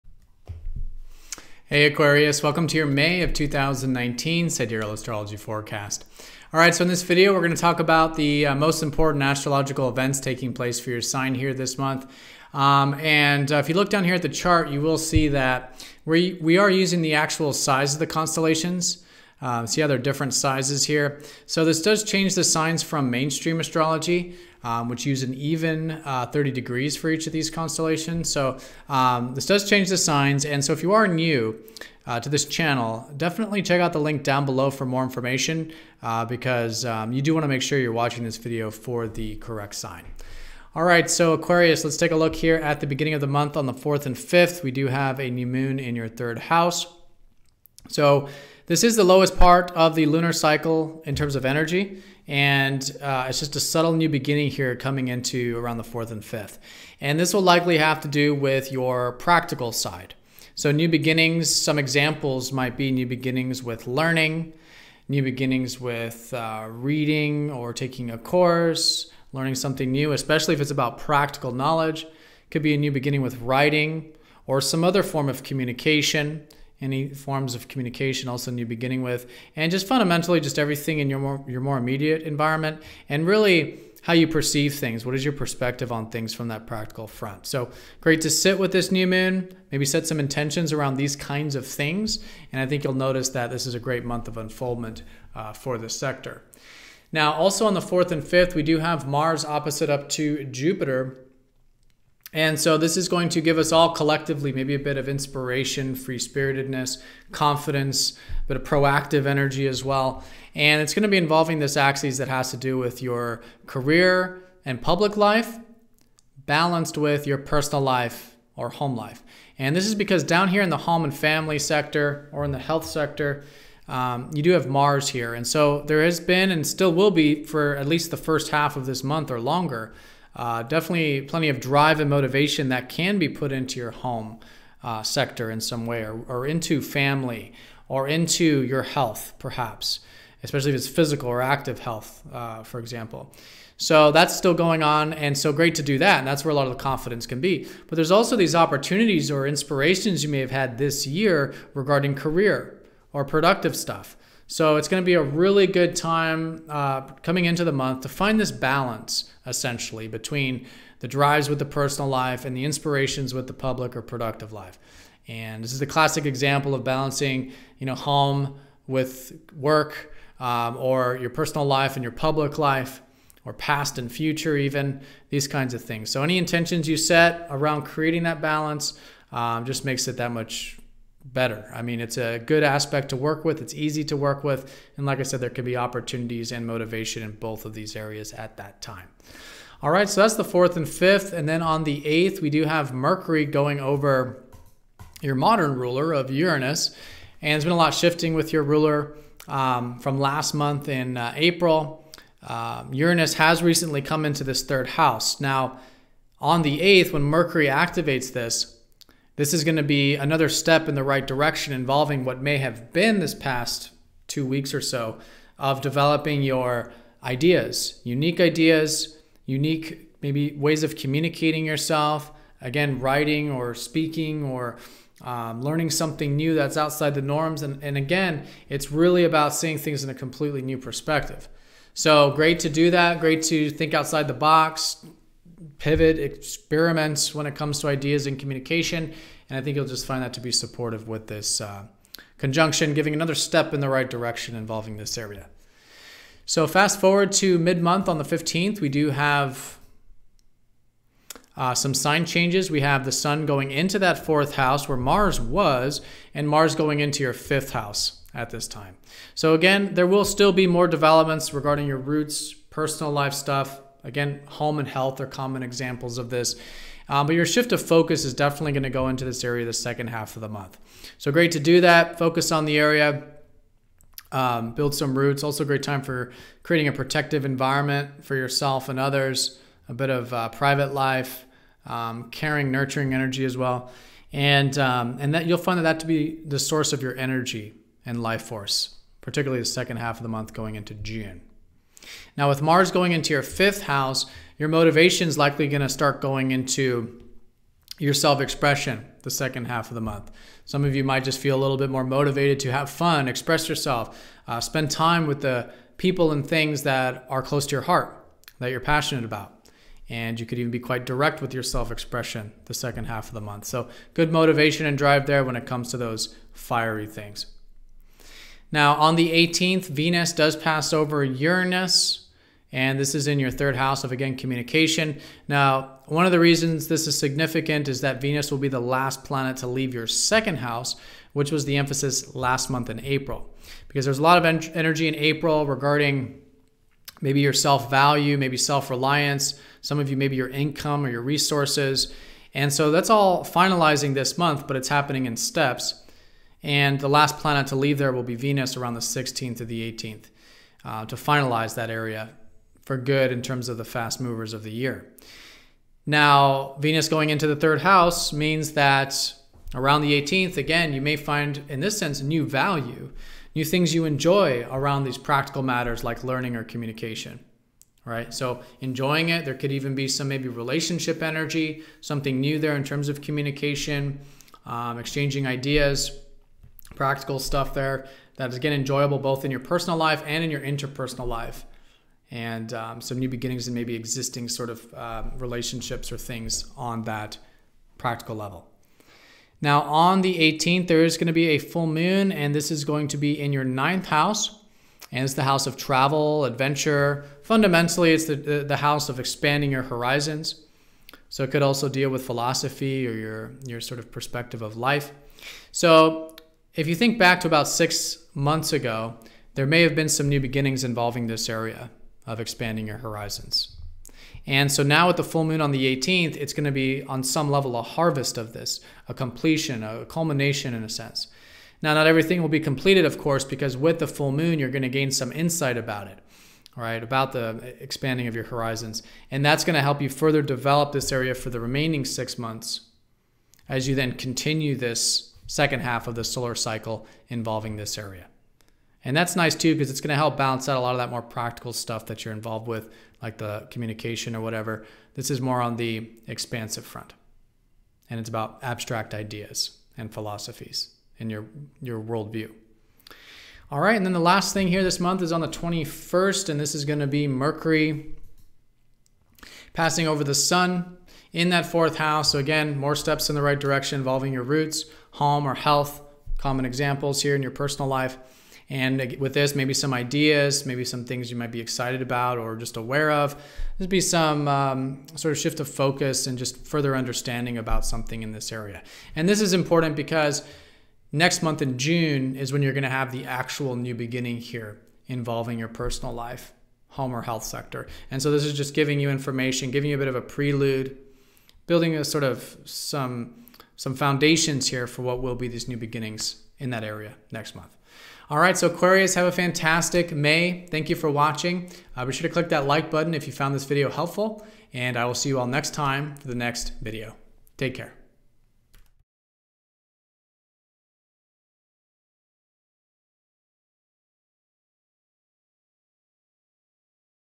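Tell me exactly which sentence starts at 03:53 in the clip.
Great to think outside the box, pivot, experiments when it comes to ideas and communication.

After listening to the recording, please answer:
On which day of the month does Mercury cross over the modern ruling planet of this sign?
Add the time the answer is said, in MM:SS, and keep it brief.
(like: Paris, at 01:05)
8th, at 03:12.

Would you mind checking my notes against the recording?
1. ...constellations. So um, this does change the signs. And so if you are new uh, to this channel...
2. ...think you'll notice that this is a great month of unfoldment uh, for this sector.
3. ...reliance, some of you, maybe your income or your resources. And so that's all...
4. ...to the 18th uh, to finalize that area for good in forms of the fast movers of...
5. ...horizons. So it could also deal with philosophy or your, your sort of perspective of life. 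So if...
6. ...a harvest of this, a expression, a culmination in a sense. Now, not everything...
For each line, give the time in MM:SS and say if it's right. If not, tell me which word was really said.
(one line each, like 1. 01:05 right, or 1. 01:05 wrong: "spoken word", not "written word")
1. 00:27 right
2. 01:32 right
3. 05:38 right
4. 05:49 wrong: "terms", not "forms"
5. 06:39 right
6. 06:57 wrong: "completion", not "expression".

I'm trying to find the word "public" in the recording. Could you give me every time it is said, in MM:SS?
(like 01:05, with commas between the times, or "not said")
01:54, 02:43, 02:52.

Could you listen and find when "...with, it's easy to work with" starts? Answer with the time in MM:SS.
03:03.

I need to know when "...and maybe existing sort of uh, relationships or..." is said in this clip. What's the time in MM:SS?
06:23.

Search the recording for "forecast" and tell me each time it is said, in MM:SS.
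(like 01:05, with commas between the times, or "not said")
00:05.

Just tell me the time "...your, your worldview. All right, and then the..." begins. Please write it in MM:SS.
07:31.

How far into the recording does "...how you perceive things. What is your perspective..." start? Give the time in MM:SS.
01:24.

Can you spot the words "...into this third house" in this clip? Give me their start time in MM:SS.
03:24.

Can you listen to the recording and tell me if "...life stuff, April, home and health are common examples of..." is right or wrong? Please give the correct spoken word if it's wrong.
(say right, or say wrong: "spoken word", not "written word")
wrong: "Again", not "April".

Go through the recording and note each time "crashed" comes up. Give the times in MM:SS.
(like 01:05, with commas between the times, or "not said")
not said.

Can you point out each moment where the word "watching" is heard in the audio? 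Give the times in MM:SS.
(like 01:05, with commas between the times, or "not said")
00:37, 08:21.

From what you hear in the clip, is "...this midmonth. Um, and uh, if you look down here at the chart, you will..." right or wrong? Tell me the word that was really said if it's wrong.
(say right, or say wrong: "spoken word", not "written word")
wrong: "month", not "midmonth".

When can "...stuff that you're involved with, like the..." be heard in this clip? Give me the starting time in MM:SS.
07:21.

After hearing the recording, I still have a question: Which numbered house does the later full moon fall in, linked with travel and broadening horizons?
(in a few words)
ninth house.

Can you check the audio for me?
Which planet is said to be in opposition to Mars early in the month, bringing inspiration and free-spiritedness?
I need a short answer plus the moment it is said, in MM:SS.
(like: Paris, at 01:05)
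Jupiter, at 01:40.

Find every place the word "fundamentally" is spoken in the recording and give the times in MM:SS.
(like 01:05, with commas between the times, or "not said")
01:19, 06:37.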